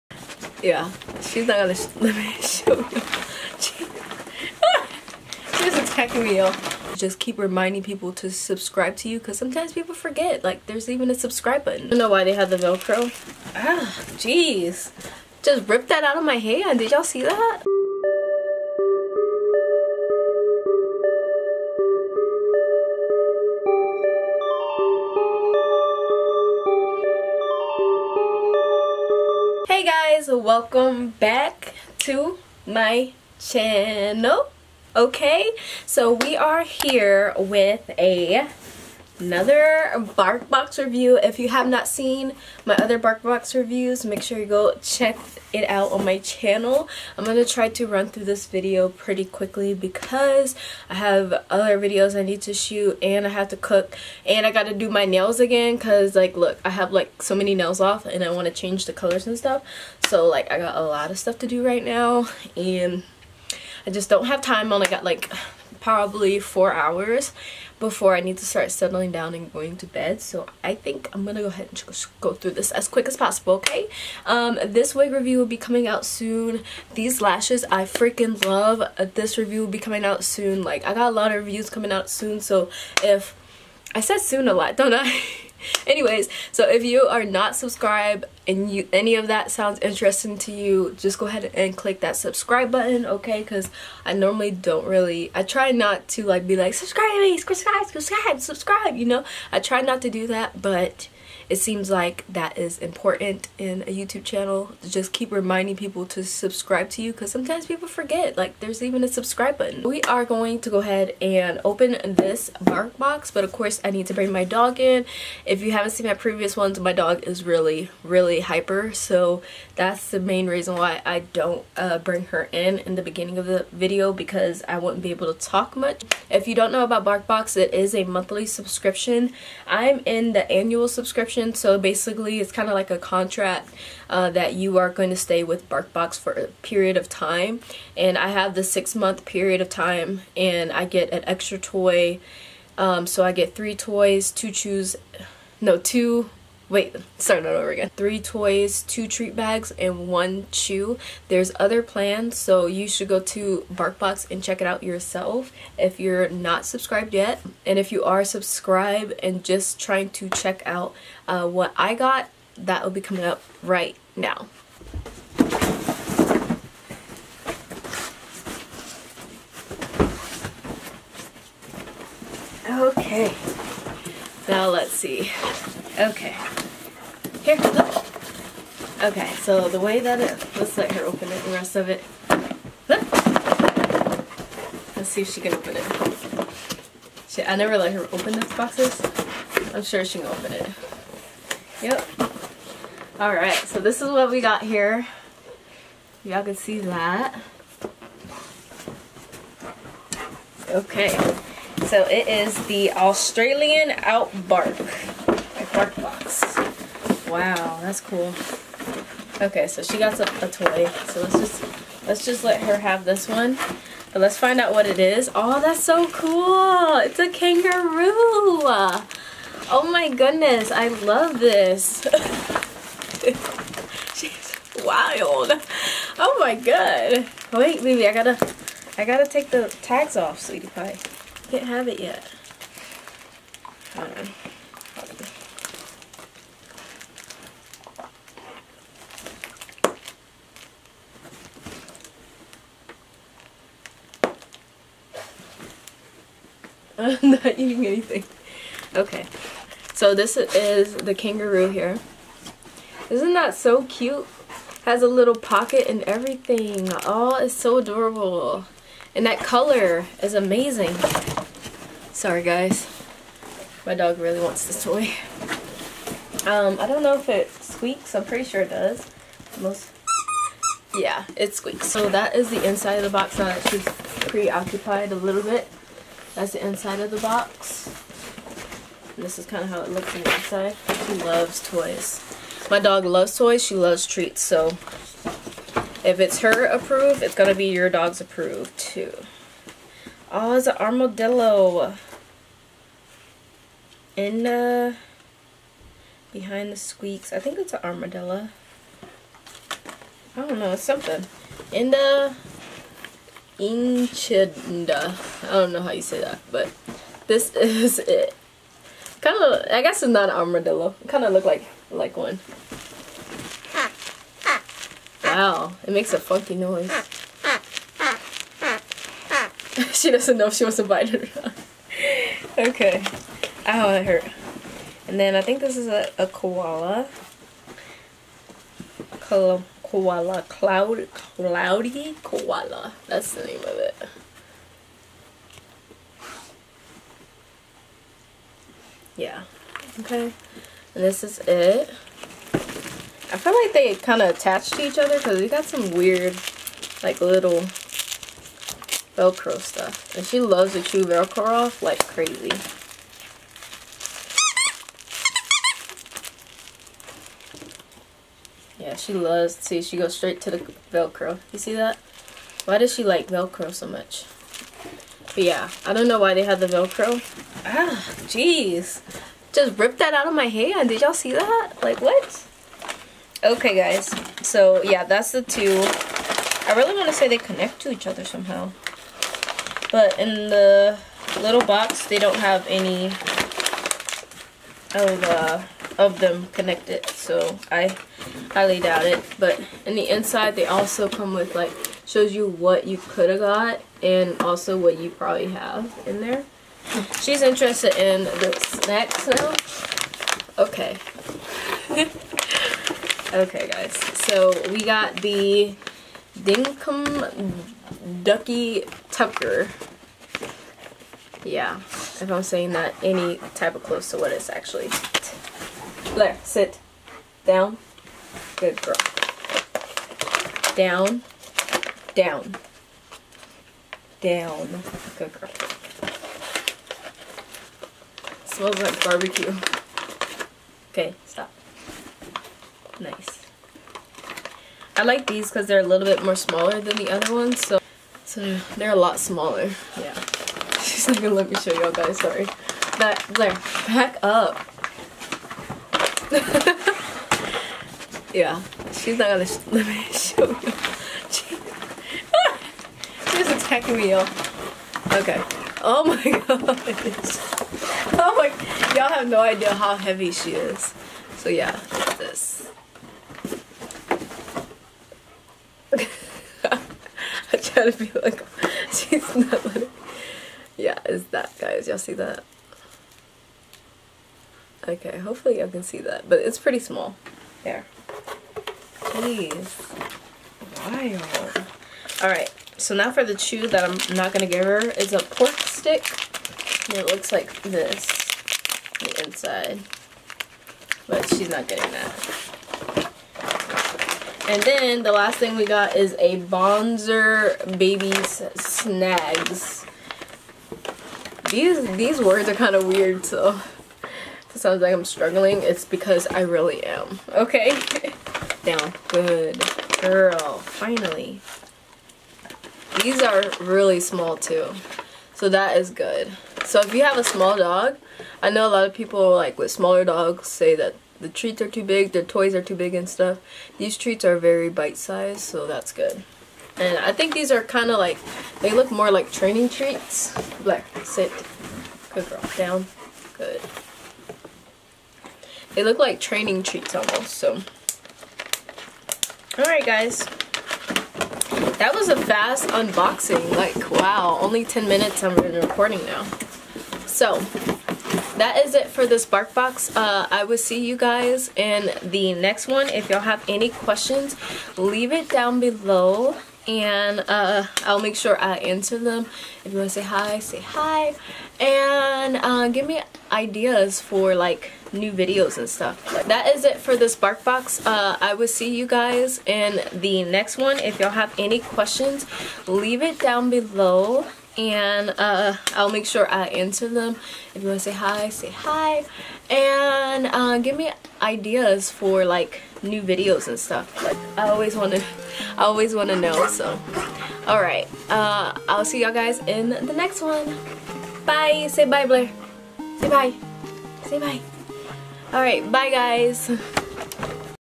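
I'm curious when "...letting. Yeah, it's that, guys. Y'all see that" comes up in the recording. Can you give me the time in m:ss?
7:49.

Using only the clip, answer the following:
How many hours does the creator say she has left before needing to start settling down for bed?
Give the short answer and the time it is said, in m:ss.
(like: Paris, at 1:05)
4, at 1:06.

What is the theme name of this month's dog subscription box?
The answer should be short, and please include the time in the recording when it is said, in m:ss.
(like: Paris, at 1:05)
Australian Outbark, at 3:22.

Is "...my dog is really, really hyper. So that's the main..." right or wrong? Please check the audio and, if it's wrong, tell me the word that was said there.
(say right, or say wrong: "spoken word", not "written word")
right.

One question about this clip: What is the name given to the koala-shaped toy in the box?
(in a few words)
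Cloudy Koala.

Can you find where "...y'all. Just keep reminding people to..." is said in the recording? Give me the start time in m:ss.
0:06.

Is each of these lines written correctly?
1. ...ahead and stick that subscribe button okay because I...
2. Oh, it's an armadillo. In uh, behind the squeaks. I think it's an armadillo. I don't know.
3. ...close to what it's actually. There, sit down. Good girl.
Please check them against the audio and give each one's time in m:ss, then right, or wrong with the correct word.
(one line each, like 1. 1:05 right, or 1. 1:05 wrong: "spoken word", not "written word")
1. 1:31 wrong: "click", not "stick"
2. 4:50 right
3. 6:53 right.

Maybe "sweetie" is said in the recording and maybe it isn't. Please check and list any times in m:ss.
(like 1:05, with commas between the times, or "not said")
3:50.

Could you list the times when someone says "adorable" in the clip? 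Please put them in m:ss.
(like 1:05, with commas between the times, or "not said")
4:17.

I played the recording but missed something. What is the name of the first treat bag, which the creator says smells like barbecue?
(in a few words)
Dinkum Ducky Tucker.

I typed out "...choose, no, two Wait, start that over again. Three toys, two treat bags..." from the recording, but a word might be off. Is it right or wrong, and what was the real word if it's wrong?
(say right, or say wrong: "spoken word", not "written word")
right.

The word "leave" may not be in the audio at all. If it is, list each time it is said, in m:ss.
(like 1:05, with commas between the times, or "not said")
9:14, 9:32.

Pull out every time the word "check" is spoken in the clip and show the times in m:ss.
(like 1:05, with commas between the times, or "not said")
0:44, 2:34, 2:40.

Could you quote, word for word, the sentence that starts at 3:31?
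So let's just let's just let her have this one.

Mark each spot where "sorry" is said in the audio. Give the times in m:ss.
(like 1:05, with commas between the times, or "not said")
4:22, 7:22.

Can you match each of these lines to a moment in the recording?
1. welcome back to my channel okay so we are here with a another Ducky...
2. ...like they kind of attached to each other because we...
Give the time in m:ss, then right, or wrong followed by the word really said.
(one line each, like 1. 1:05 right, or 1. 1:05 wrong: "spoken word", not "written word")
1. 0:30 wrong: "BarkBox", not "Ducky"
2. 5:43 right.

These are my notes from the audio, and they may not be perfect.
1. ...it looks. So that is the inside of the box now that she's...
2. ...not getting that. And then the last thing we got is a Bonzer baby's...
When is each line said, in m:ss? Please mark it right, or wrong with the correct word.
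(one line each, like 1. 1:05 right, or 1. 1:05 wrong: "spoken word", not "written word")
1. 4:31 wrong: "squeaks", not "looks"
2. 8:11 right.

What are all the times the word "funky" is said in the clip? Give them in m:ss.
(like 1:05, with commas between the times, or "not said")
5:16.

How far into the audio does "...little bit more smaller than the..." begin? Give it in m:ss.
7:15.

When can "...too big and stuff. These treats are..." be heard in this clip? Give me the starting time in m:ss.
8:42.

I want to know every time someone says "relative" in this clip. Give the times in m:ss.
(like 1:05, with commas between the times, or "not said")
not said.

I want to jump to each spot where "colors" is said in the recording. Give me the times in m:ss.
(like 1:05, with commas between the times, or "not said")
0:58, 4:19.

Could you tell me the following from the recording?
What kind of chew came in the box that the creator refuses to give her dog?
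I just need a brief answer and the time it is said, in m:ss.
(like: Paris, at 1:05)
Pork stick, at 8:05.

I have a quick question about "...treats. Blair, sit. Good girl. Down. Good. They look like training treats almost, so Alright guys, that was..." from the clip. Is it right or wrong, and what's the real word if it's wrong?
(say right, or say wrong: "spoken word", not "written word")
right.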